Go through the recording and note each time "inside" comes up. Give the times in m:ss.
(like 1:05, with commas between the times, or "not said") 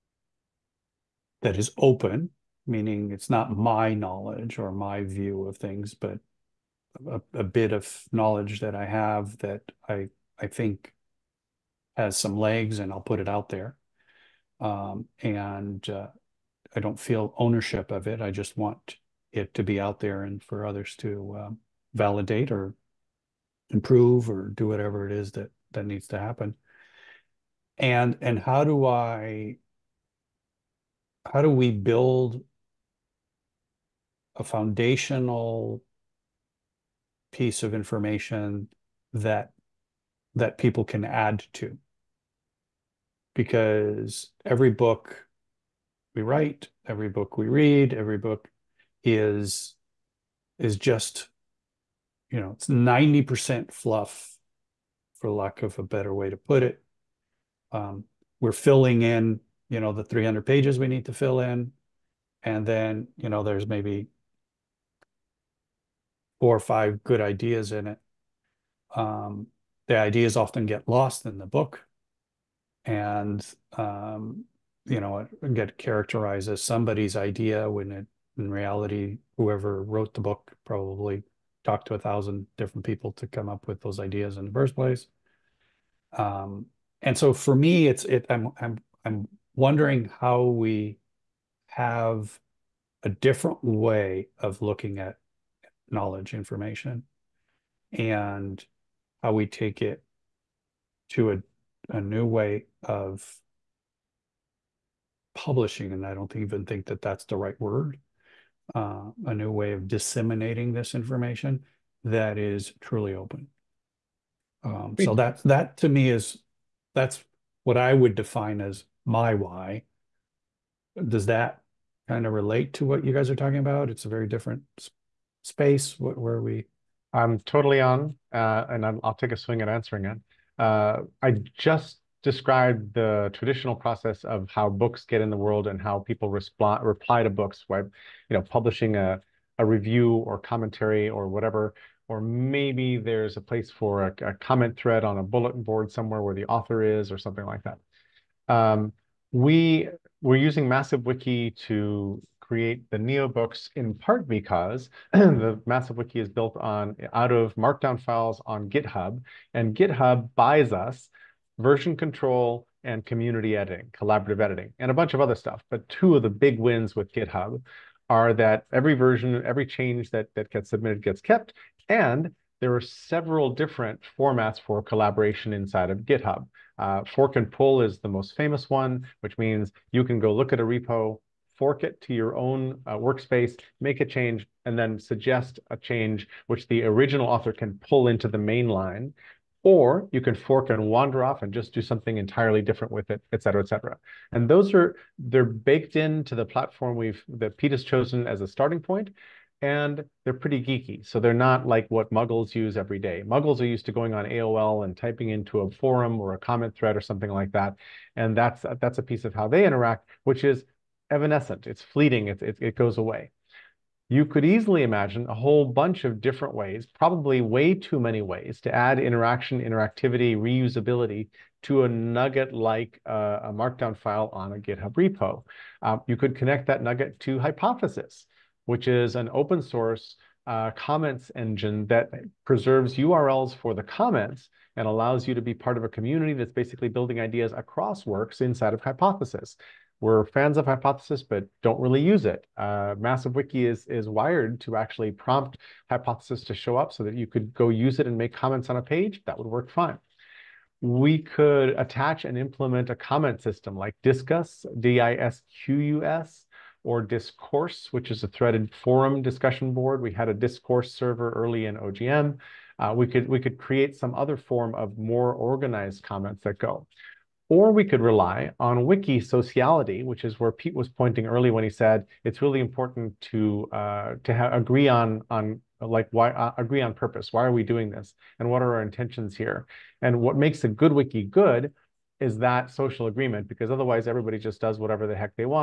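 2:55, 3:58.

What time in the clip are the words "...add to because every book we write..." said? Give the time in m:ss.
0:41.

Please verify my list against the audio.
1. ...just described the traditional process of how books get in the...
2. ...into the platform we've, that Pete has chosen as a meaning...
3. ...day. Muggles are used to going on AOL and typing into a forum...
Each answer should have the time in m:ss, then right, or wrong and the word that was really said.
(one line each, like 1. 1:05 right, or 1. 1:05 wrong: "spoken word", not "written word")
1. 2:11 right
2. 3:15 wrong: "starting", not "meaning"
3. 3:22 right.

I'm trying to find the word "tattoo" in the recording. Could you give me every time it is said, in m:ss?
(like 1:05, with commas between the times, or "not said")
not said.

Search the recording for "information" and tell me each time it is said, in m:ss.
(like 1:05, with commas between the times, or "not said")
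0:37, 1:36, 1:50.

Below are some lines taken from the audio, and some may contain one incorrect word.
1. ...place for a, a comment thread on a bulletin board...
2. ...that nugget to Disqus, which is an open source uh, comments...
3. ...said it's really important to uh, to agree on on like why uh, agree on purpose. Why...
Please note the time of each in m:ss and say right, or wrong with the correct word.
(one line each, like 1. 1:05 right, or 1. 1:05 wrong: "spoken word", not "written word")
1. 2:23 right
2. 3:46 wrong: "Hypothesis", not "Disqus"
3. 4:31 right.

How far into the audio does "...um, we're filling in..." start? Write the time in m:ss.
0:57.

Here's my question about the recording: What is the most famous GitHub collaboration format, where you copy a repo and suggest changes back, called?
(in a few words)
Fork and pull.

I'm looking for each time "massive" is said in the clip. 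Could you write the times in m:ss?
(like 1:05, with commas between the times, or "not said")
2:30, 2:35, 4:02.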